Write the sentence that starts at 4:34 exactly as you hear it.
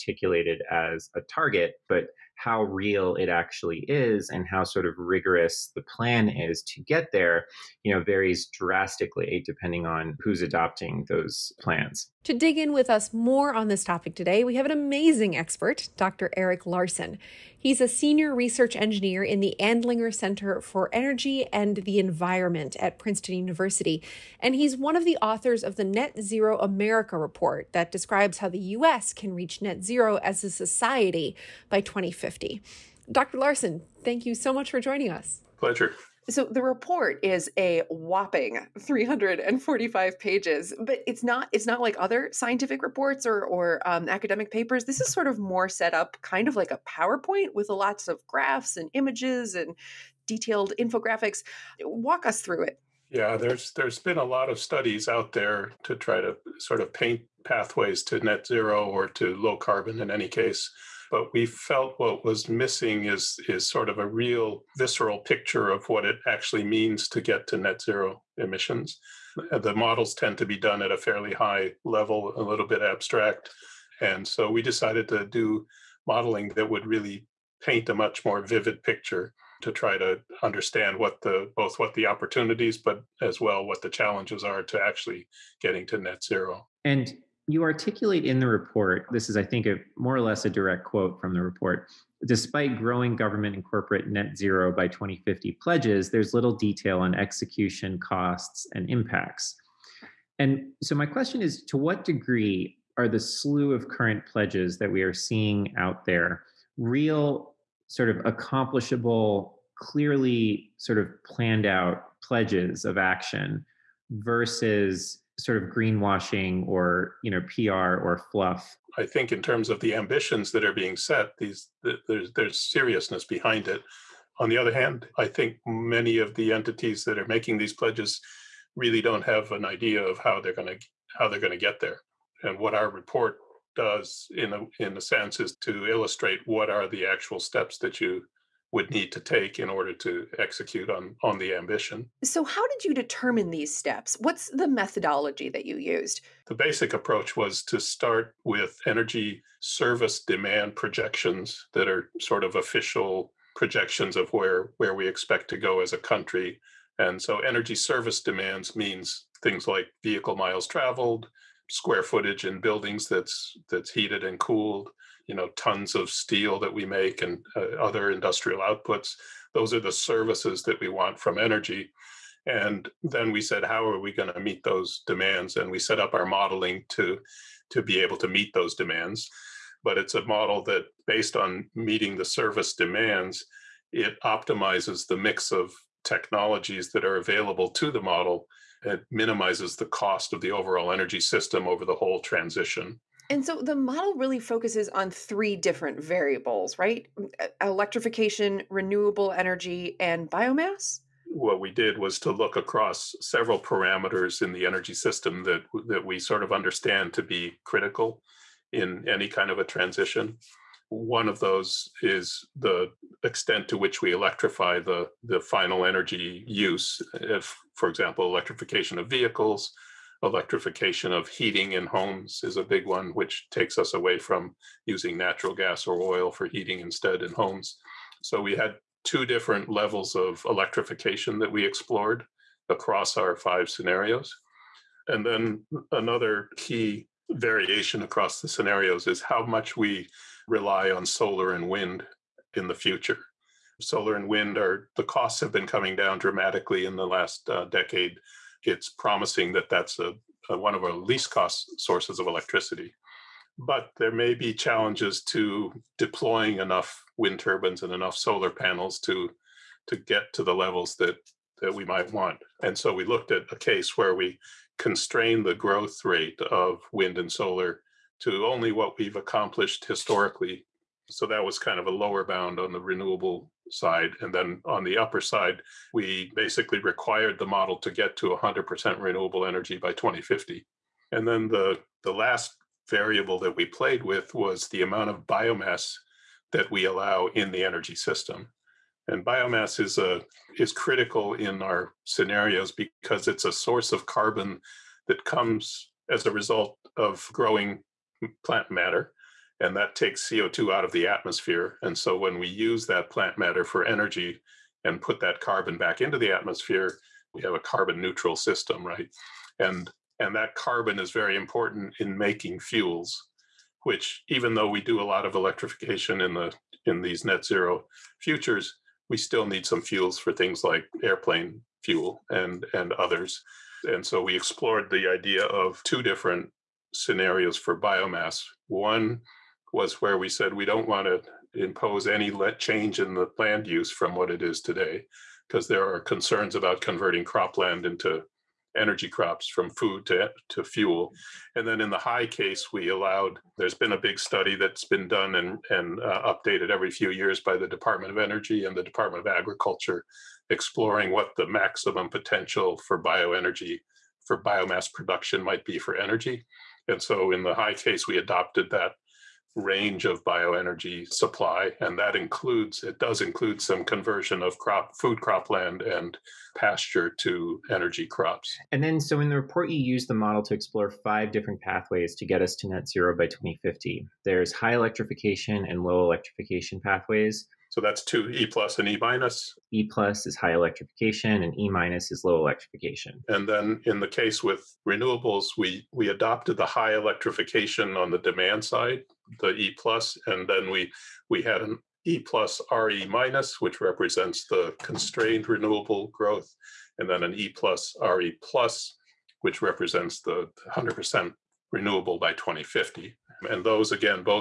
And then on the upper side, we basically required the model to get to 100% renewable energy by 2050.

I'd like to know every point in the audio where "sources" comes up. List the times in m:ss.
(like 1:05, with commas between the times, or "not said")
4:11, 4:53.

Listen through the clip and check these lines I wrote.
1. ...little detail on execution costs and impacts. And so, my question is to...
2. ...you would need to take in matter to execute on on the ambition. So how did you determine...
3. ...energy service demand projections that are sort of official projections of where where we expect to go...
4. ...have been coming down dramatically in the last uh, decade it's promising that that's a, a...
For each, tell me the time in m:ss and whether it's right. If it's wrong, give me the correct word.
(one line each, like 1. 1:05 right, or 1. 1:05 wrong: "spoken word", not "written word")
1. 1:36 right
2. 2:18 wrong: "order", not "matter"
3. 2:28 right
4. 4:05 right.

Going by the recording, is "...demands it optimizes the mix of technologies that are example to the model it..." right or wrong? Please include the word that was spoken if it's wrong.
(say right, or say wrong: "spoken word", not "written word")
wrong: "available", not "example".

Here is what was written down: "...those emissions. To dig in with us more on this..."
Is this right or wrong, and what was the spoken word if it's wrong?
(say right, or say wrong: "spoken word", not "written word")
wrong: "plans", not "emissions".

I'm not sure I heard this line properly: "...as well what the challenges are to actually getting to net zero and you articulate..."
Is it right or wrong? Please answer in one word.
right.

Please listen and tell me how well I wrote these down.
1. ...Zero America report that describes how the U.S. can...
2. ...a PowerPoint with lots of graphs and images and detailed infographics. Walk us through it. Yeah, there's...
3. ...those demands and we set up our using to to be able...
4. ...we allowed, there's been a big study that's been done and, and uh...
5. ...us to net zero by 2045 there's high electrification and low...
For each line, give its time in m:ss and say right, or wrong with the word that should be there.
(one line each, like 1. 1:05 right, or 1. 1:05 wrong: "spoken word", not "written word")
1. 0:26 right
2. 0:46 right
3. 2:54 wrong: "modeling", not "using"
4. 5:42 right
5. 6:12 wrong: "2050", not "2045".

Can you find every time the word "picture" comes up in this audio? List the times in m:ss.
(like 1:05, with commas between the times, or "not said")
1:05, 1:18.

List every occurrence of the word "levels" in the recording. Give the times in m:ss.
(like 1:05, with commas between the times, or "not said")
1:11, 3:49, 4:20.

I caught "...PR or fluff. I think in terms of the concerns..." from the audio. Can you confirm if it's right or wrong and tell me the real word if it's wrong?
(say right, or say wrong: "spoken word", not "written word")
wrong: "ambitions", not "concerns".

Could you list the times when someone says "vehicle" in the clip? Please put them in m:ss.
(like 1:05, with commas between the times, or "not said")
2:40, 3:39.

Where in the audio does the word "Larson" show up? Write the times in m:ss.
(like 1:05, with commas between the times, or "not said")
0:16, 0:33.